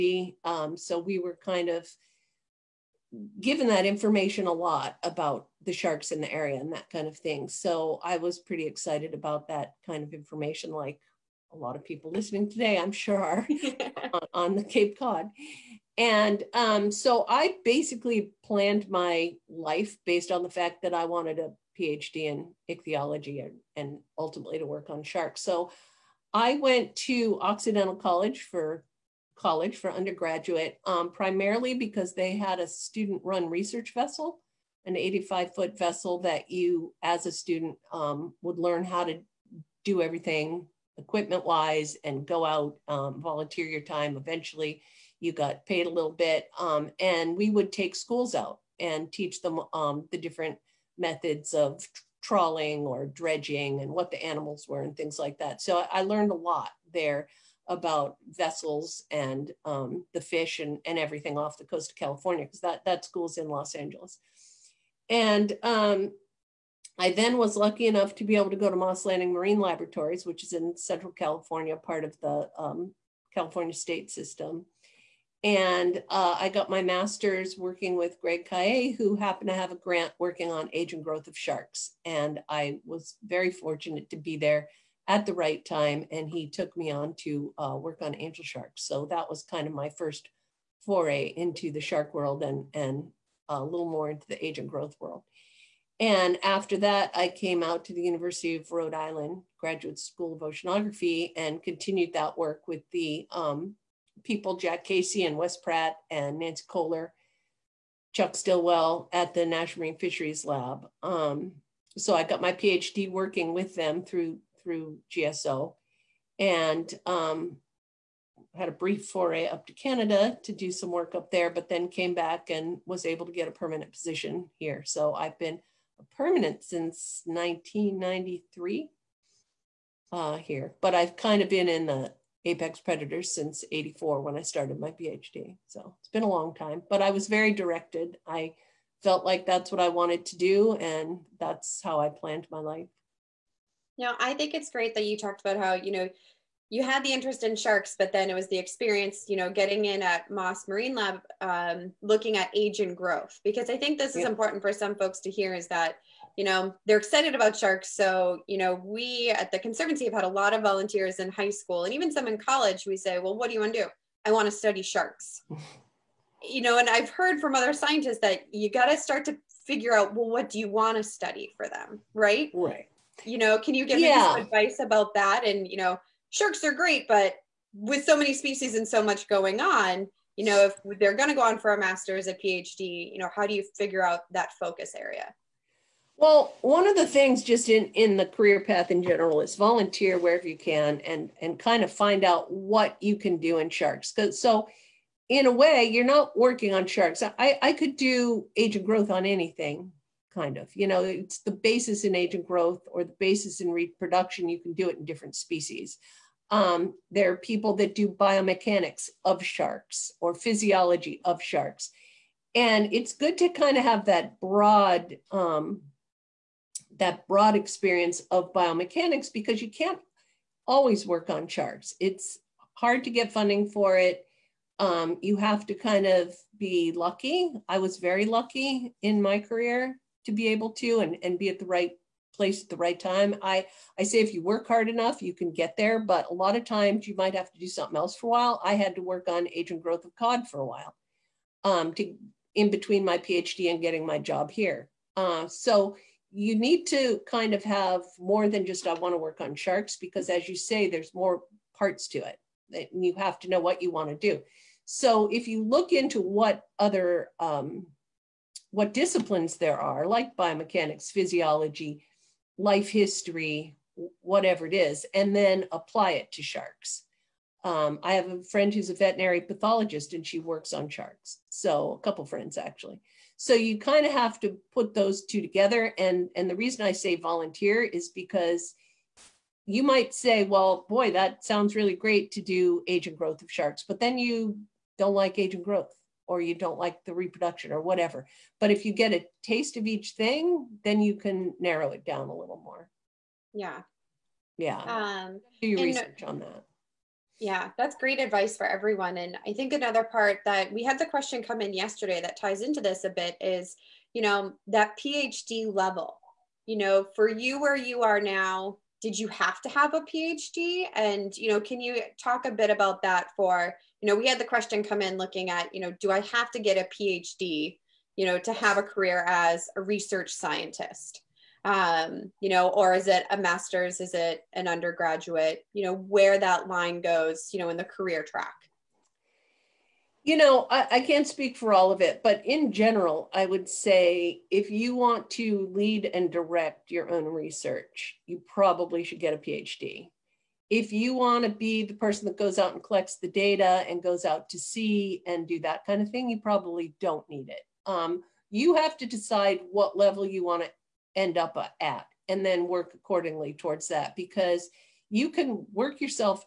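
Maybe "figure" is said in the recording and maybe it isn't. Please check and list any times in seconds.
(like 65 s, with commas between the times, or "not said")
169 s, 183 s.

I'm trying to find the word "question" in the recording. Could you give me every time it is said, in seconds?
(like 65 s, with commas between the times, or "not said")
301 s, 314 s.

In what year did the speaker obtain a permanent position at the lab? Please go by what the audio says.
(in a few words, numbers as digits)
1993.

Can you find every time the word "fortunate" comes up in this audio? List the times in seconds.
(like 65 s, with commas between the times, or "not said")
83 s.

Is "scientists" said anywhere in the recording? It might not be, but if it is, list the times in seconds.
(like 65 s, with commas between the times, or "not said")
167 s, 320 s.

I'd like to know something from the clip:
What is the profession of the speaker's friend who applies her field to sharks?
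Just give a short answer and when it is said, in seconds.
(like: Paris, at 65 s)
veterinary pathologist, at 268 s.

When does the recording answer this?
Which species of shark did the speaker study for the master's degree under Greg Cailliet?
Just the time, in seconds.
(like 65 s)
88 s.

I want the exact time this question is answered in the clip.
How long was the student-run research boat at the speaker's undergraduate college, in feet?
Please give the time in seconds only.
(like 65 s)
34 s.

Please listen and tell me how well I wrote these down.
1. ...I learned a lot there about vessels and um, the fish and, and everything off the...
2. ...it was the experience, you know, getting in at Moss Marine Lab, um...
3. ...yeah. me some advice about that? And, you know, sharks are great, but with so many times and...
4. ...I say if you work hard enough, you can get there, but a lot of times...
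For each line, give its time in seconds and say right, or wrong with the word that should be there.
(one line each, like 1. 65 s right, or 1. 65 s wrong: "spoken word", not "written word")
1. 55 s right
2. 148 s right
3. 173 s wrong: "species", not "times"
4. 233 s right.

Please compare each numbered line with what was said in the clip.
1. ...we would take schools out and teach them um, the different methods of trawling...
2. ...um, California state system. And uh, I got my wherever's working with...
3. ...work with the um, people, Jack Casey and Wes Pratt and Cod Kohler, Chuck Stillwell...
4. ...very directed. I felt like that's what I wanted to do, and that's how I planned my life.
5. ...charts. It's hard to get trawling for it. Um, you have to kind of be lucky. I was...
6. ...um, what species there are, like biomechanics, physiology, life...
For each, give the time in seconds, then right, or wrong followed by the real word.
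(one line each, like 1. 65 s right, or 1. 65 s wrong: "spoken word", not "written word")
1. 47 s right
2. 72 s wrong: "master", not "wherever"
3. 102 s wrong: "Nancy", not "Cod"
4. 137 s right
5. 221 s wrong: "funding", not "trawling"
6. 257 s wrong: "disciplines", not "species".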